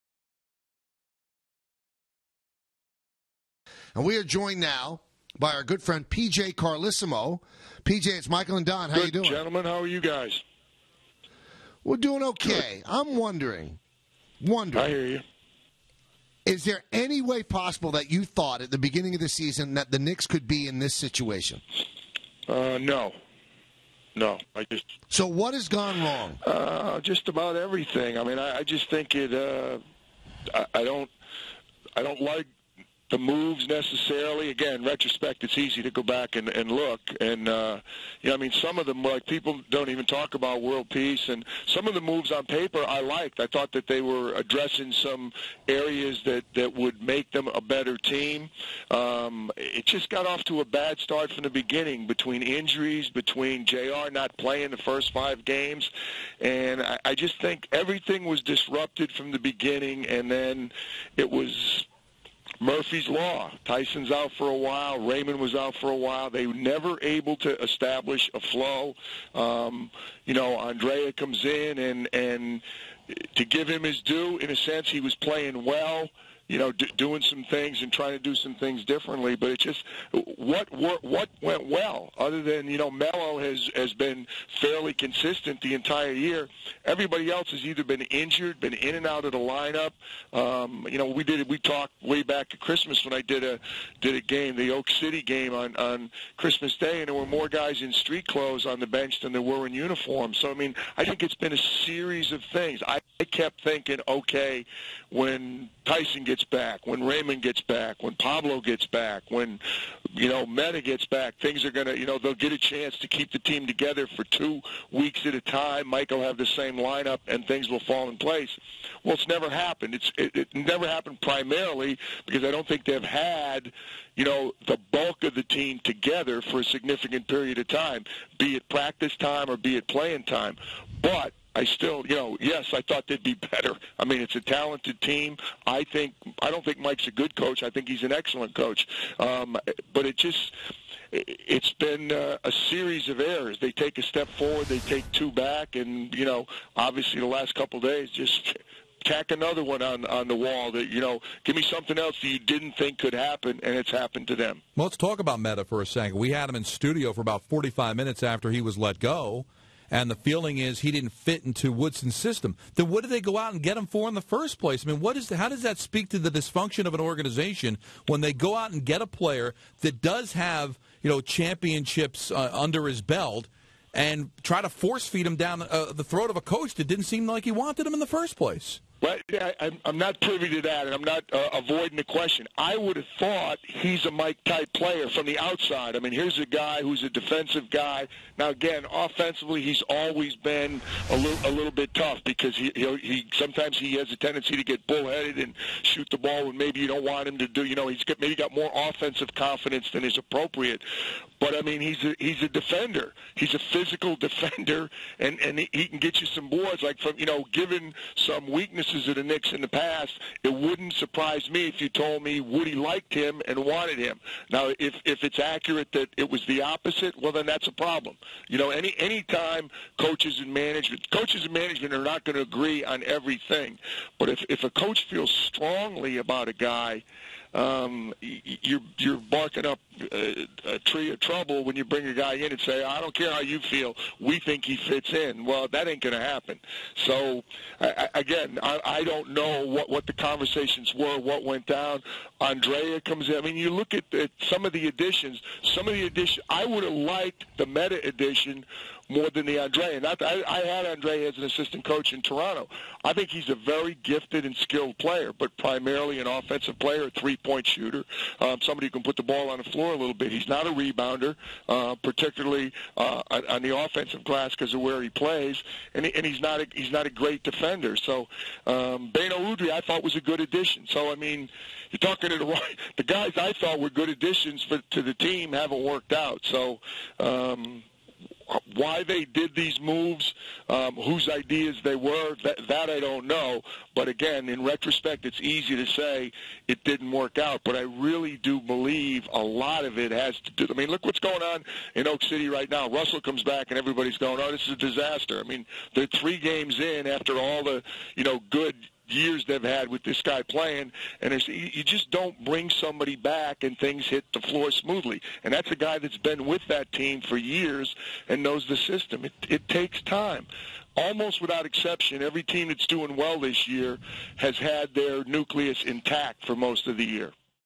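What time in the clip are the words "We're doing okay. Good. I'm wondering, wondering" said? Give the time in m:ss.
0:11.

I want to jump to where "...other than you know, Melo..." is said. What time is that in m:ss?
1:22.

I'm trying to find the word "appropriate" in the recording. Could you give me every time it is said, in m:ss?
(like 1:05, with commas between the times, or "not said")
3:20.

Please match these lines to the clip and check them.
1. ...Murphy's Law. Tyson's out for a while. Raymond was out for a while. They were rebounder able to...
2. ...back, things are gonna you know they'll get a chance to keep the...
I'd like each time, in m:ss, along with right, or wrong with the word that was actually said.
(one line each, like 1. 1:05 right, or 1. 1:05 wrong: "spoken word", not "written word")
1. 1:02 wrong: "never", not "rebounder"
2. 1:51 right.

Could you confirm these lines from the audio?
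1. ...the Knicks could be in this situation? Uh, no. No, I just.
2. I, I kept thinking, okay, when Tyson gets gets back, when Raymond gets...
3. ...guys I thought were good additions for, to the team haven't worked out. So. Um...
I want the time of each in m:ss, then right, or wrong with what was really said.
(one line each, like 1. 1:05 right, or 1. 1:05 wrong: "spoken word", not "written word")
1. 0:19 right
2. 1:42 right
3. 4:33 right.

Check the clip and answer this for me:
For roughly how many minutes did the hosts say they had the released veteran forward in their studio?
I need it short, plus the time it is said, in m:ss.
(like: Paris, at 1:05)
45, at 2:37.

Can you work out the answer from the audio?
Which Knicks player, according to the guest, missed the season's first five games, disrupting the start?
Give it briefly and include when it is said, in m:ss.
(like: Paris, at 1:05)
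JR, at 0:53.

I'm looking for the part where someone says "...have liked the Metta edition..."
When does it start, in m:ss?
4:06.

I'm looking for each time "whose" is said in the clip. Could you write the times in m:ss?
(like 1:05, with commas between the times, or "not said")
4:40.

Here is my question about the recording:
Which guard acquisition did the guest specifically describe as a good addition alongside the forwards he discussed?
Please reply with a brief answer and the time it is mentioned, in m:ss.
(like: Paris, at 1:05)
Beno Udrih, at 4:29.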